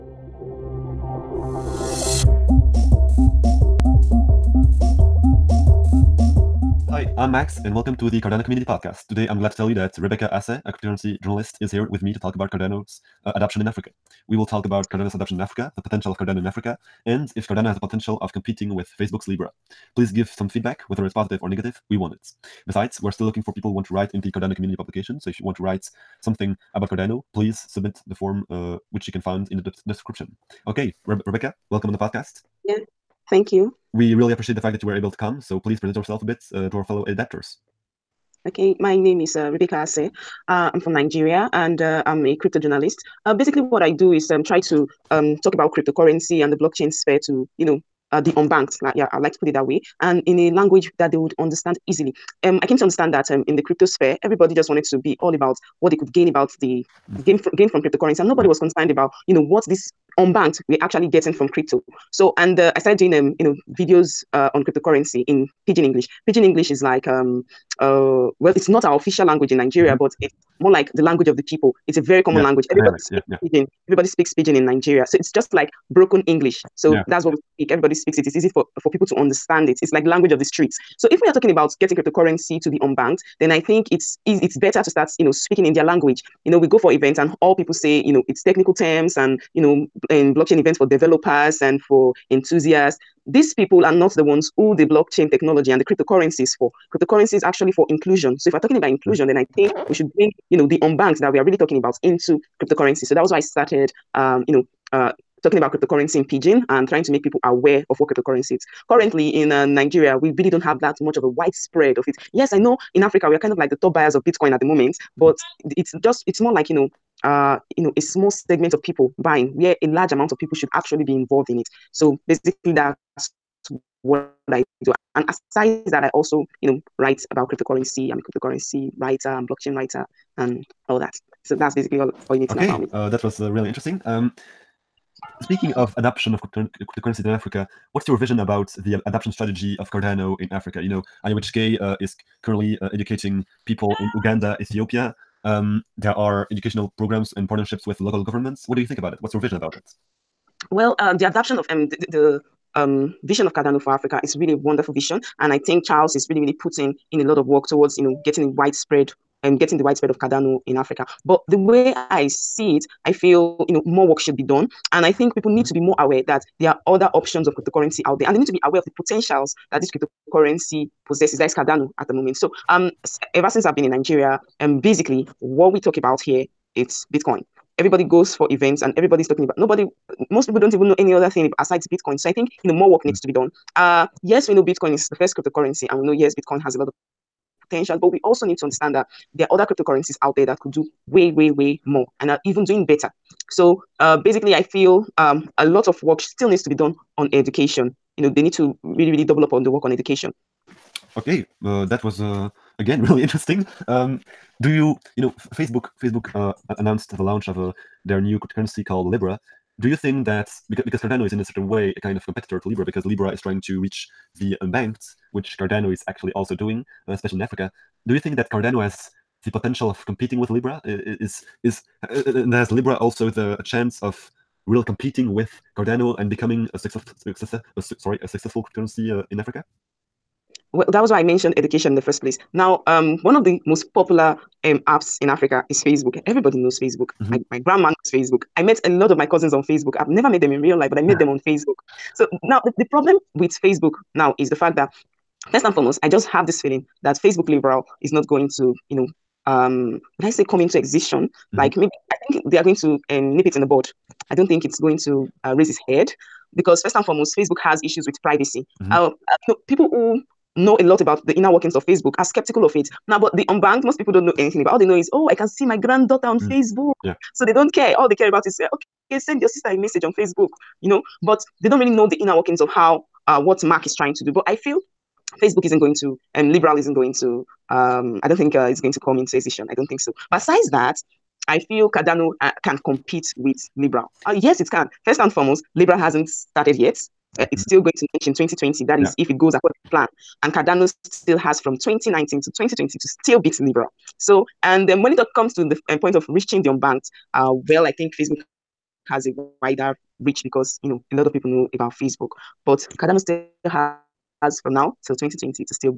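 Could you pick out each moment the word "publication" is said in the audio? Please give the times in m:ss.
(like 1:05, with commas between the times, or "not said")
0:24.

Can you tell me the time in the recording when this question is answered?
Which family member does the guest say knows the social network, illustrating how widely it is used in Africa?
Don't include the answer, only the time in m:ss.
3:57.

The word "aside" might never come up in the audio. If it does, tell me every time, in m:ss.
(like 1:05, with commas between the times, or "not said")
2:05, 3:01.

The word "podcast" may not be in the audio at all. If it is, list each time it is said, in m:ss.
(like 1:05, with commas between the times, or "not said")
0:08, 0:31.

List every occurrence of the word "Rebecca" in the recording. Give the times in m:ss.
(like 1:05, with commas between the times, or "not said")
0:09, 0:31, 0:39.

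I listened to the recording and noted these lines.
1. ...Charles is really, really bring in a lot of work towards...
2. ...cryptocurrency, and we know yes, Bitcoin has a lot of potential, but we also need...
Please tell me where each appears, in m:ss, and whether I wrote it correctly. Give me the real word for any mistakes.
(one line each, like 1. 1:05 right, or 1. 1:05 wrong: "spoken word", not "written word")
1. 2:35 wrong: "putting", not "bring"
2. 3:05 right.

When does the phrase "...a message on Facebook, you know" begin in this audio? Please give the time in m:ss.
4:29.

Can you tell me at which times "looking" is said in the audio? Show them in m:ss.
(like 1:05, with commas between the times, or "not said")
0:23.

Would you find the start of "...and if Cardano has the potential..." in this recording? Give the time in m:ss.
0:17.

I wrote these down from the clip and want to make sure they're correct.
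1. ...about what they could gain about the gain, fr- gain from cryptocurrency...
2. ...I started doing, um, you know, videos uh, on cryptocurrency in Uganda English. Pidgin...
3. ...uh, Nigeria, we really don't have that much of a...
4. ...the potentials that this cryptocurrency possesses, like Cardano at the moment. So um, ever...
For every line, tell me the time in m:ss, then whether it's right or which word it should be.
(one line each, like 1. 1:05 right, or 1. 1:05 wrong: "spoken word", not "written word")
1. 0:55 right
2. 1:02 wrong: "Pidgin", not "Uganda"
3. 1:49 right
4. 2:48 right.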